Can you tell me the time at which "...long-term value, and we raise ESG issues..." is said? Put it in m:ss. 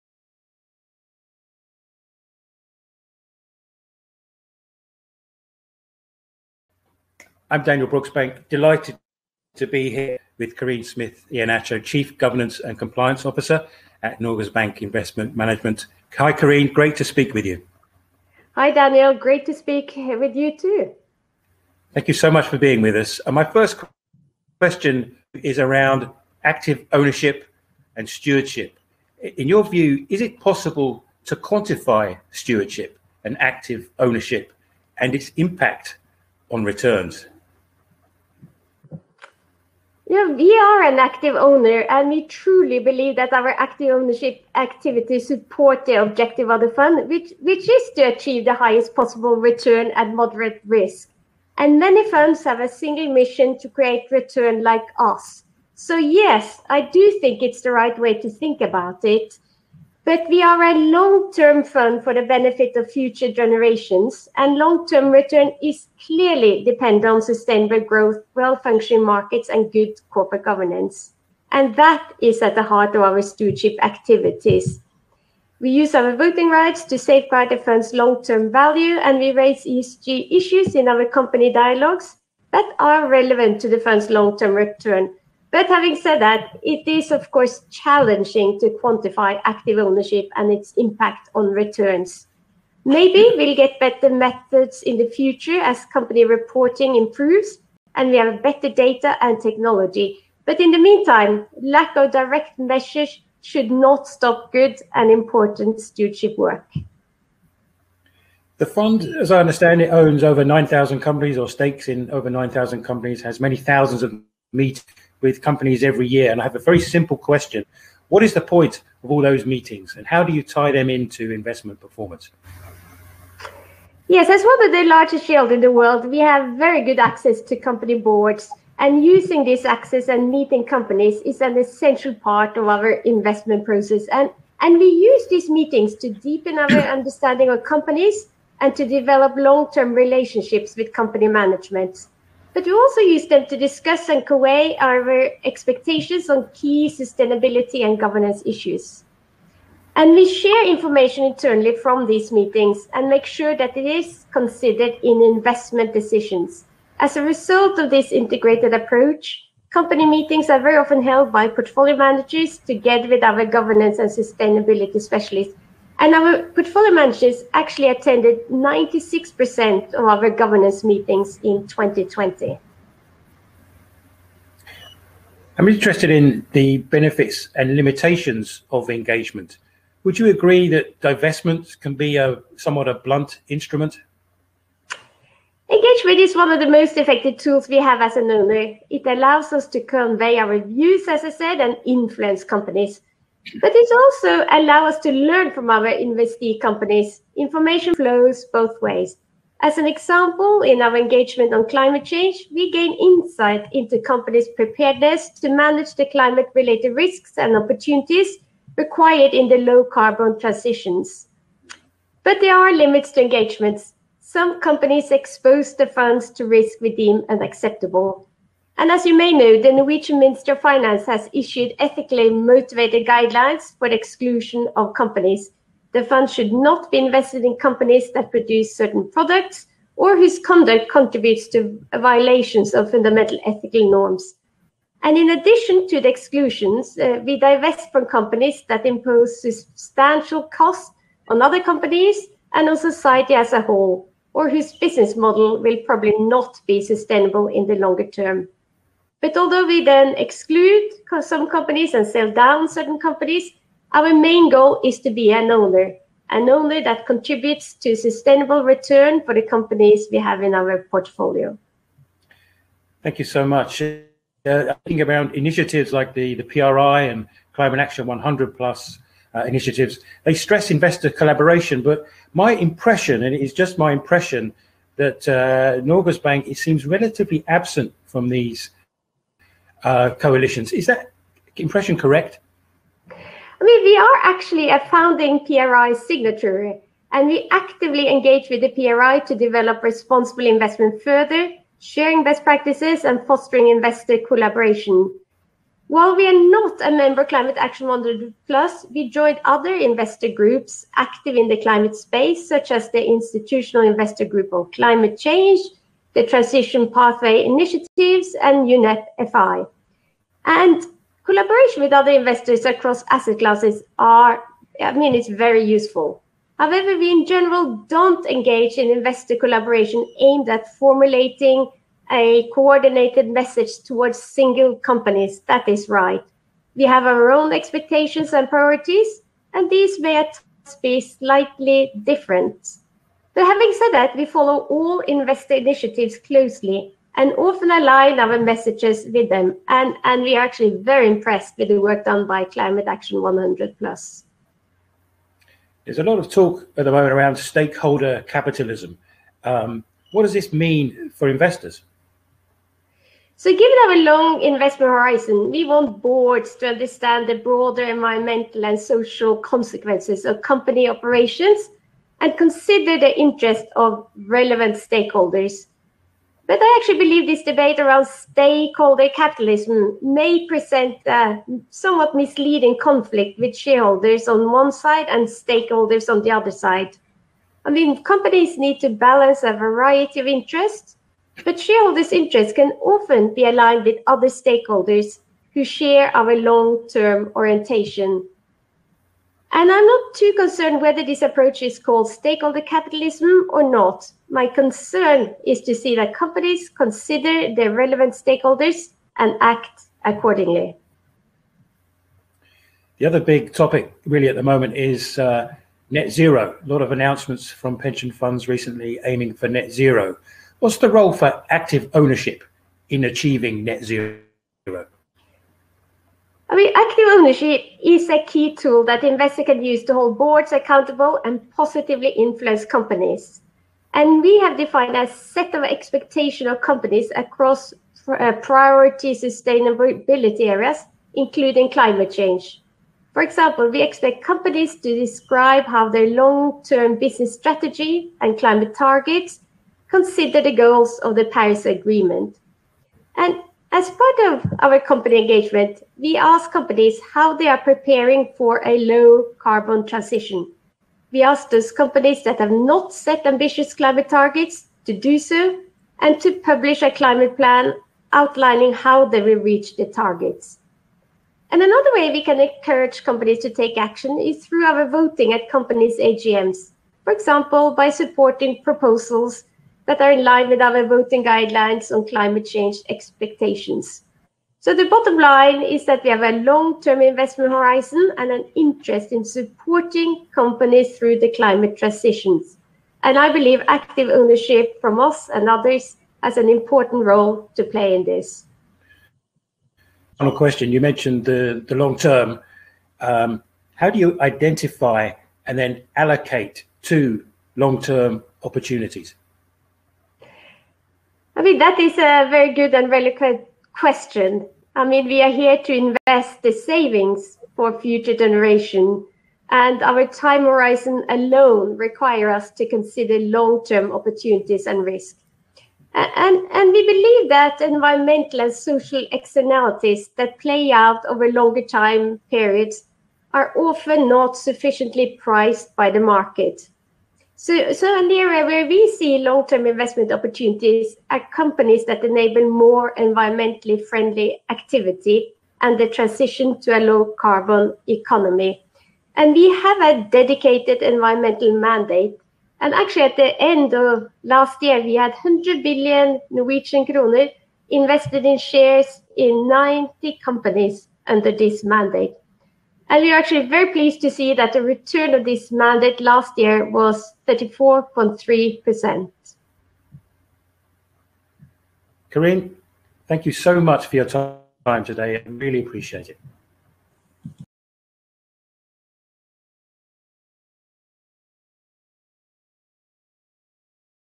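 1:17.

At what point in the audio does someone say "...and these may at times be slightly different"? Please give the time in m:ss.
5:29.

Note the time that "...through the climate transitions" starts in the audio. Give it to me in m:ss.
8:00.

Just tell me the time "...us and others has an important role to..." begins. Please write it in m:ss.
8:05.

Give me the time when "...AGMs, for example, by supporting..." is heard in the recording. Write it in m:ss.
7:45.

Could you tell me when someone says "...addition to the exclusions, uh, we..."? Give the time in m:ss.
3:55.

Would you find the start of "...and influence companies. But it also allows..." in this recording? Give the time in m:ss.
3:11.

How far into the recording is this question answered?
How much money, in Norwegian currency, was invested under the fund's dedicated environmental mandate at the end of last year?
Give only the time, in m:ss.
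9:05.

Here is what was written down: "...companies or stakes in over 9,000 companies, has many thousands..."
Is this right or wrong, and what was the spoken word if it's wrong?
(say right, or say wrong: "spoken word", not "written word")
right.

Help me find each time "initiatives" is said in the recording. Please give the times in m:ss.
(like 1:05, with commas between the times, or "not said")
4:25, 4:29, 5:07, 5:35.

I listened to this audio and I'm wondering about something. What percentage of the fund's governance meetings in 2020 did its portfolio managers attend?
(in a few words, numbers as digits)
96%.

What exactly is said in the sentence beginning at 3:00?
Would you agree that divestment can be a somewhat a blunt instrument?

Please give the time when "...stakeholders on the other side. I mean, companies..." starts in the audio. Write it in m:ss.
6:15.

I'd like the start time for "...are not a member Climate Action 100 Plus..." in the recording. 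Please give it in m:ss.
4:56.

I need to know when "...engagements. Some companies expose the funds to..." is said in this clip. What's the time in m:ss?
3:33.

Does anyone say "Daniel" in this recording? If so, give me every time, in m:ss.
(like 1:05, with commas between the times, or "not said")
0:07, 0:18.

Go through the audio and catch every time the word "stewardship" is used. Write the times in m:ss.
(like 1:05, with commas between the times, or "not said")
0:28, 0:32, 1:13, 1:45.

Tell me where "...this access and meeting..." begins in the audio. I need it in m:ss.
2:09.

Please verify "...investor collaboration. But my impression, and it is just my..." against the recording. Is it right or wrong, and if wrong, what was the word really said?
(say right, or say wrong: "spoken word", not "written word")
right.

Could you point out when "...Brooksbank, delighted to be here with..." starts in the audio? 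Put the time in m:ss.
0:07.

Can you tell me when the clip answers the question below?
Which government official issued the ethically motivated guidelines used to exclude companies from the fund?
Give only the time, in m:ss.
3:39.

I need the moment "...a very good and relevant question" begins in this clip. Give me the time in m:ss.
8:21.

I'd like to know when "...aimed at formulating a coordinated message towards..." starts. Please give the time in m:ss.
5:20.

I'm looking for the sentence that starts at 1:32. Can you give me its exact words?
Maybe we'll get better methods in the future as company reporting improves and we have better data and technology.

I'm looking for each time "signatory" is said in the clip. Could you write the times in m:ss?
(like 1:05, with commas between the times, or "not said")
4:45.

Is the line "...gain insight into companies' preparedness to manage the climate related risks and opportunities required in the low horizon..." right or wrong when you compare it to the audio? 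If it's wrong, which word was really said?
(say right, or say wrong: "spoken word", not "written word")
wrong: "carbon", not "horizon".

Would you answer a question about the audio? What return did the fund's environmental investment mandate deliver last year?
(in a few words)
34.3%.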